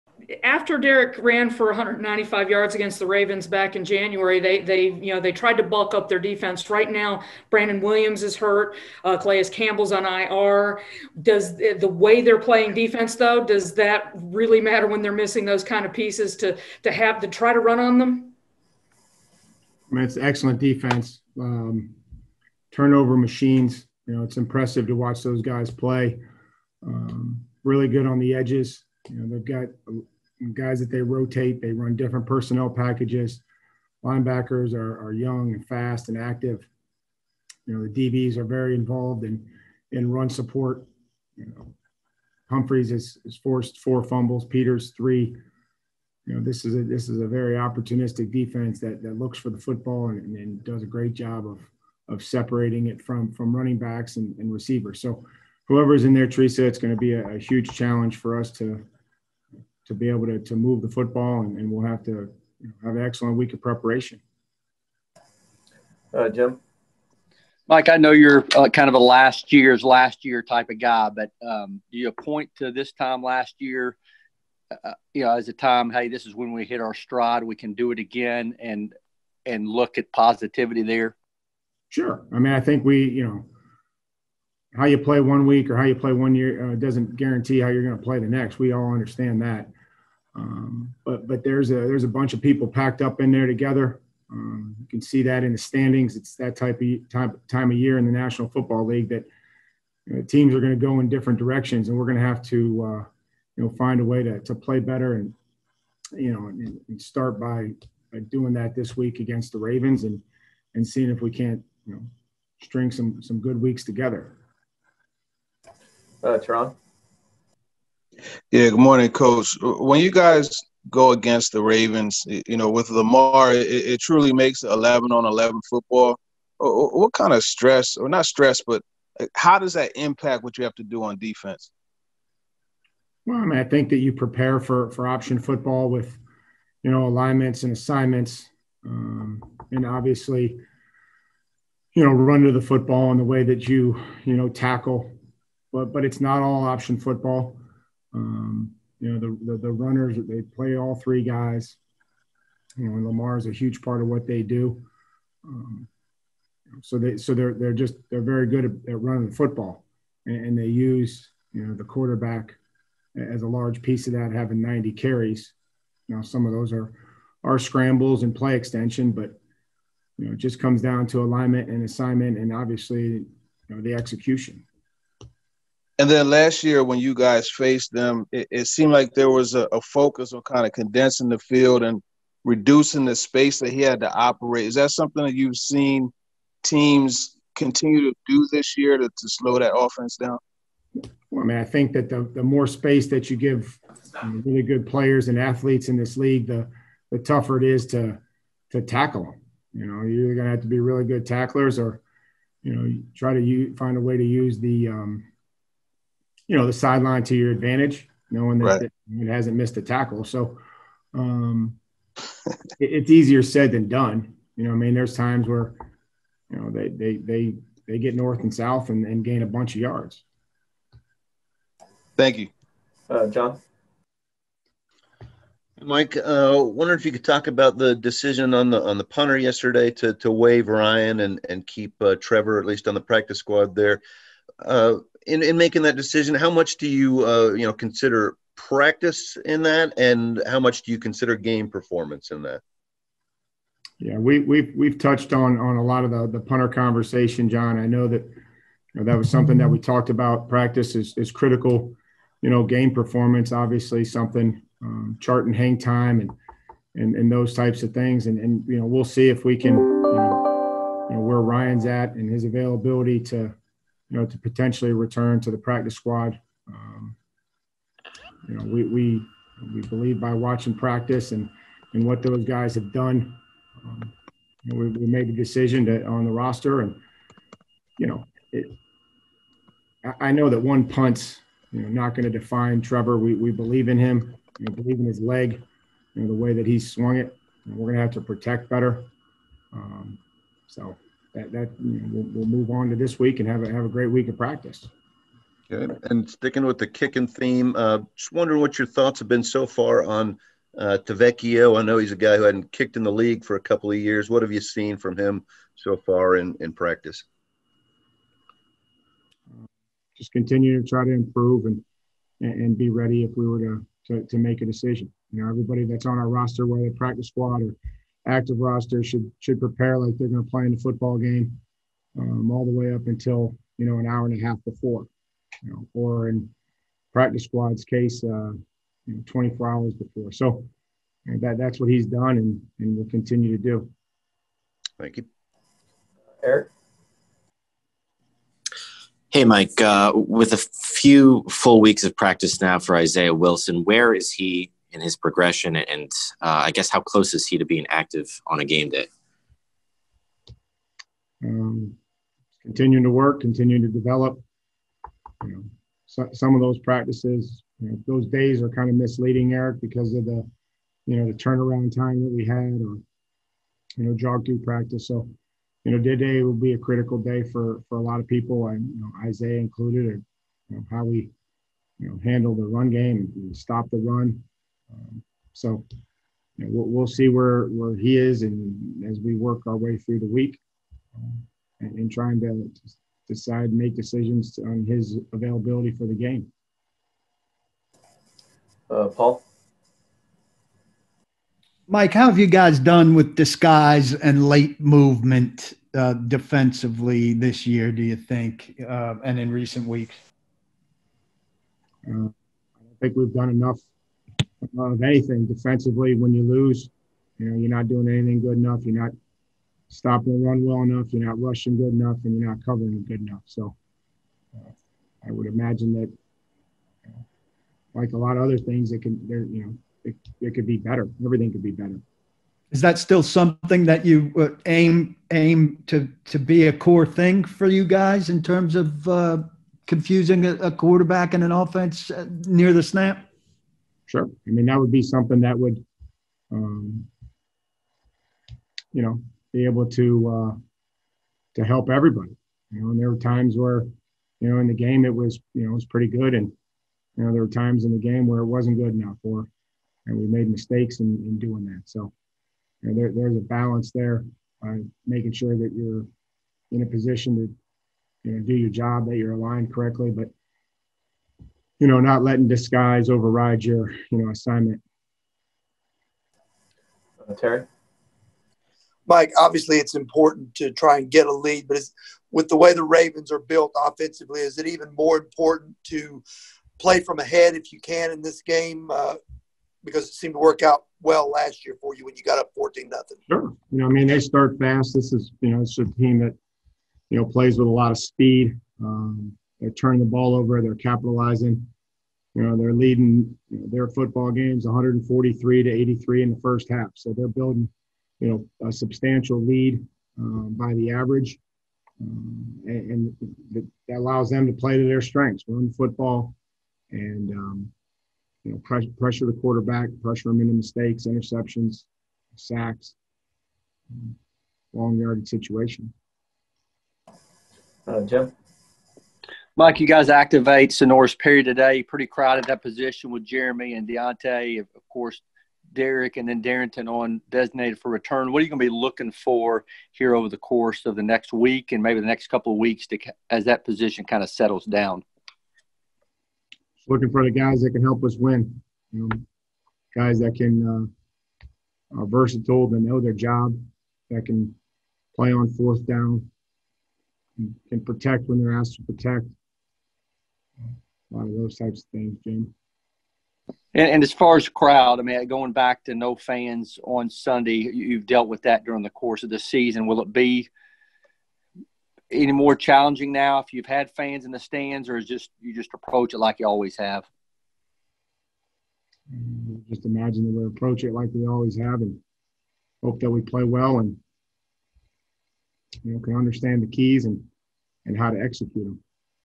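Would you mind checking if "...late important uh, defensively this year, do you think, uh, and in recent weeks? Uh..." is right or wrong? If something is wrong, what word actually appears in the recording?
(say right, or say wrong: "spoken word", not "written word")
wrong: "movement", not "important".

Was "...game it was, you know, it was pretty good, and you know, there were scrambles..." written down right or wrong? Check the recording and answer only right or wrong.
wrong.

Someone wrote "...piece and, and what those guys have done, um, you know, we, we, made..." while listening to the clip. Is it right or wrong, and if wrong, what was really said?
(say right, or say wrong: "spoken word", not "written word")
wrong: "practice", not "piece".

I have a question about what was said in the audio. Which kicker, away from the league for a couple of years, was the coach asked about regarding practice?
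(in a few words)
Tavecchio.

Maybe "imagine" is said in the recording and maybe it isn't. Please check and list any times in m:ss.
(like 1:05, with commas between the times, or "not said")
6:55, 9:29.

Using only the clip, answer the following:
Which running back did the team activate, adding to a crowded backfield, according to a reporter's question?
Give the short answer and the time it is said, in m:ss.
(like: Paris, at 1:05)
Senorise Perry, at 8:40.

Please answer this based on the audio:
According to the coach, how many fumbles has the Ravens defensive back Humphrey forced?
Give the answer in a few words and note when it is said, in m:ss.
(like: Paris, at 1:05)
4, at 0:43.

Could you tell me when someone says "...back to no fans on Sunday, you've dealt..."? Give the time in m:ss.
9:15.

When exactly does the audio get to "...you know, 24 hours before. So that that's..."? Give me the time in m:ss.
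5:29.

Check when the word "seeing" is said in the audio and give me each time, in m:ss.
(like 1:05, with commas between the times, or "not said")
1:50.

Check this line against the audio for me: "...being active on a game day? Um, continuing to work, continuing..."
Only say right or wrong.
right.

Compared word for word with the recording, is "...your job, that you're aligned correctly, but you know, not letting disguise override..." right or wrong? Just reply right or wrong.
right.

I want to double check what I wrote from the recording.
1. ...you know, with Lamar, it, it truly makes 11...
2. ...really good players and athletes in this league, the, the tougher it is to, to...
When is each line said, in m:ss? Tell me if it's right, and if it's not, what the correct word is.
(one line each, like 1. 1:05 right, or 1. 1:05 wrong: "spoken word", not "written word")
1. 2:02 right
2. 3:14 right.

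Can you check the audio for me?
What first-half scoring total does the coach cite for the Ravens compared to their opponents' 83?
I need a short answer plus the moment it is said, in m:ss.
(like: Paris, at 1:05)
143, at 8:14.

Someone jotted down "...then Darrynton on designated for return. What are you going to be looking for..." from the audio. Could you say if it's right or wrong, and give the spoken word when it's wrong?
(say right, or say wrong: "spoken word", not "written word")
right.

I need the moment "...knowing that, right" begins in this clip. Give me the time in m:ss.
3:28.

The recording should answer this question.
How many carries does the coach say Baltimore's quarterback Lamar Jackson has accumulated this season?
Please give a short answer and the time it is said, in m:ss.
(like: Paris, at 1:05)
90, at 2:44.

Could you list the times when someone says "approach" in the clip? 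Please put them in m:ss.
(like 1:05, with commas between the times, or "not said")
9:25, 9:30.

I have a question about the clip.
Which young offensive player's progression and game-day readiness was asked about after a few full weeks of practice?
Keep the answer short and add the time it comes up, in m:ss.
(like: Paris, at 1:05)
Isaiah Wilson, at 5:42.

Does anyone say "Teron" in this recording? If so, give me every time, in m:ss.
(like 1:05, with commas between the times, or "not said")
1:56.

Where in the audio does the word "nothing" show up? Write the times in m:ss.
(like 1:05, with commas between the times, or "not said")
8:02.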